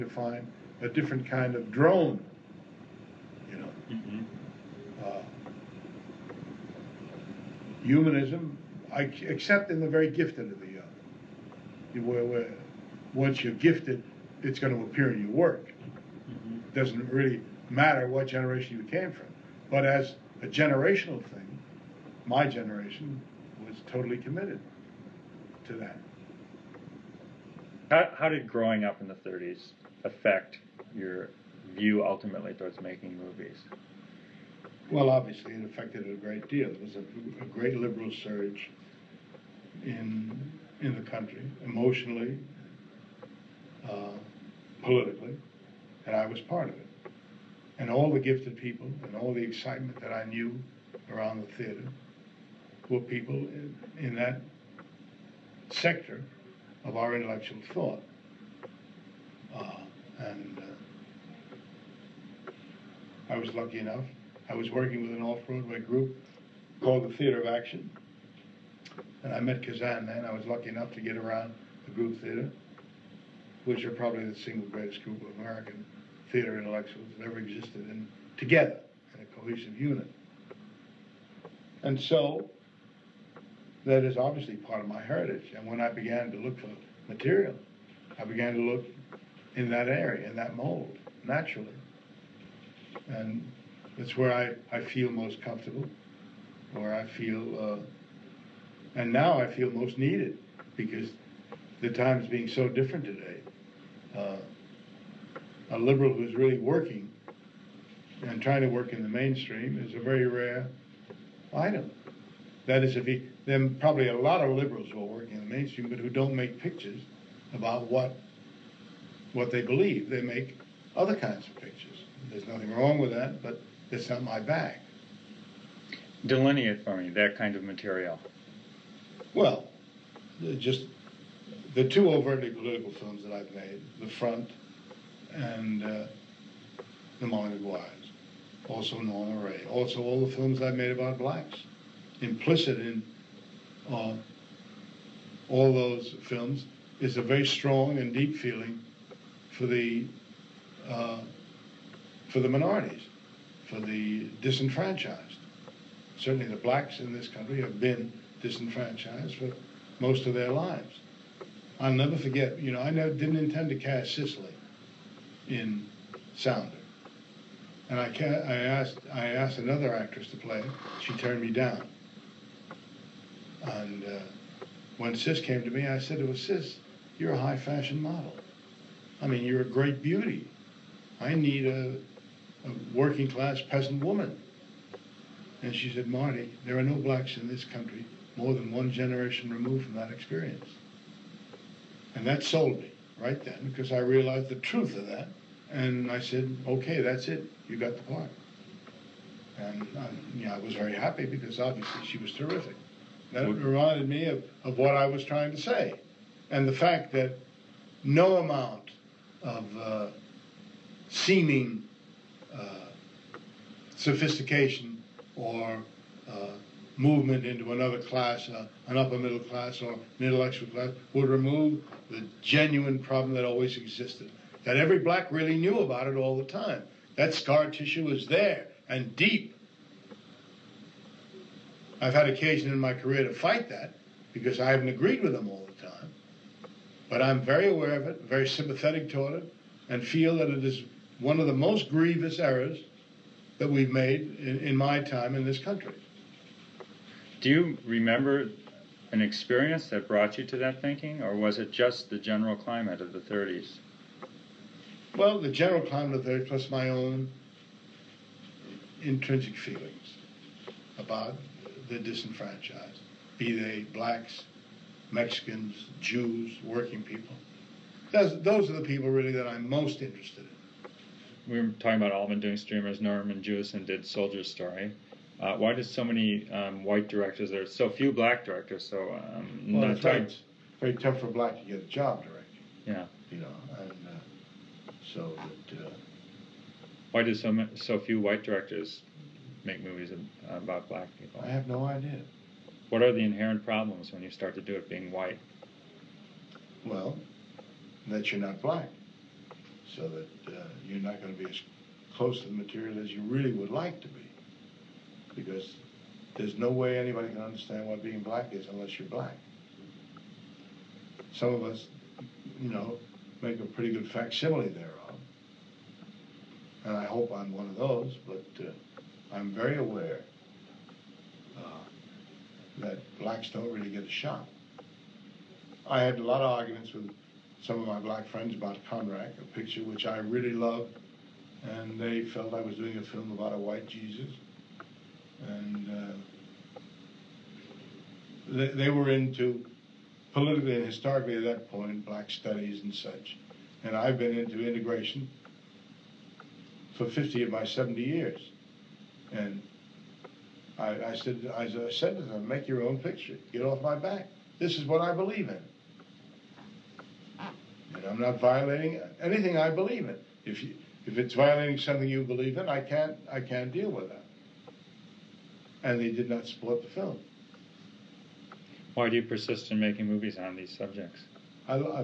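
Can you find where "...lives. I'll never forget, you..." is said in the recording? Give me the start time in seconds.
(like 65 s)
160 s.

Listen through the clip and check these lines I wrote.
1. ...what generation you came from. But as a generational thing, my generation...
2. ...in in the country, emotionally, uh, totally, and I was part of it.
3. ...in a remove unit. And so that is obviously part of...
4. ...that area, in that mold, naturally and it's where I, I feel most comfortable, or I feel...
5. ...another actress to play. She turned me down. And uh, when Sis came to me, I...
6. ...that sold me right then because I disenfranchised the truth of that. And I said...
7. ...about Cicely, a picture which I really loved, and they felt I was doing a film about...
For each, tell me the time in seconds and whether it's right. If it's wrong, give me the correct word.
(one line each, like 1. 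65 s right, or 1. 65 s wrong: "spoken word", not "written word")
1. 18 s right
2. 39 s wrong: "politically", not "totally"
3. 79 s wrong: "cohesive", not "remove"
4. 89 s right
5. 169 s right
6. 192 s wrong: "realized", not "disenfranchised"
7. 328 s wrong: "Conrack", not "Cicely".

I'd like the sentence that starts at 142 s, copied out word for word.
Implicit in uh, all those films is a very strong and deep feeling for the uh, for the minorities, for the disenfranchised.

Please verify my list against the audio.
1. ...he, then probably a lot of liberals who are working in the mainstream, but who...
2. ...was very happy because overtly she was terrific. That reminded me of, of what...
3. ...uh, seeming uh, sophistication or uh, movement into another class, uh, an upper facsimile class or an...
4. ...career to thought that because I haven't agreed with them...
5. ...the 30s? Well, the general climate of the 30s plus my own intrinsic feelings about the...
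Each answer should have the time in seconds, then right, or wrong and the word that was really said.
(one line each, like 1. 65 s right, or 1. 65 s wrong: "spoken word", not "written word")
1. 113 s right
2. 200 s wrong: "obviously", not "overtly"
3. 209 s wrong: "middle", not "facsimile"
4. 232 s wrong: "fight", not "thought"
5. 253 s right.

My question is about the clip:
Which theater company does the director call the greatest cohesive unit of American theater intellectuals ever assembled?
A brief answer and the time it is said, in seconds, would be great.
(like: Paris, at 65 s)
the Group Theater, at 71 s.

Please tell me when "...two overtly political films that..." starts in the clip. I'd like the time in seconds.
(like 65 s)
131 s.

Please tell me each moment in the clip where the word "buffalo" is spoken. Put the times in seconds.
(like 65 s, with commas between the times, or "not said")
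not said.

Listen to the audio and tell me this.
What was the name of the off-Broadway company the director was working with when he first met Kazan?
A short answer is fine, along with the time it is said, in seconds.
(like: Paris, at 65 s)
Theater of Action, at 67 s.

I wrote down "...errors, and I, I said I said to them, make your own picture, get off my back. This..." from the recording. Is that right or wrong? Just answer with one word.
wrong.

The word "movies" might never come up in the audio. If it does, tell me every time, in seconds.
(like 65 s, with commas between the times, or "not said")
33 s, 289 s, 370 s.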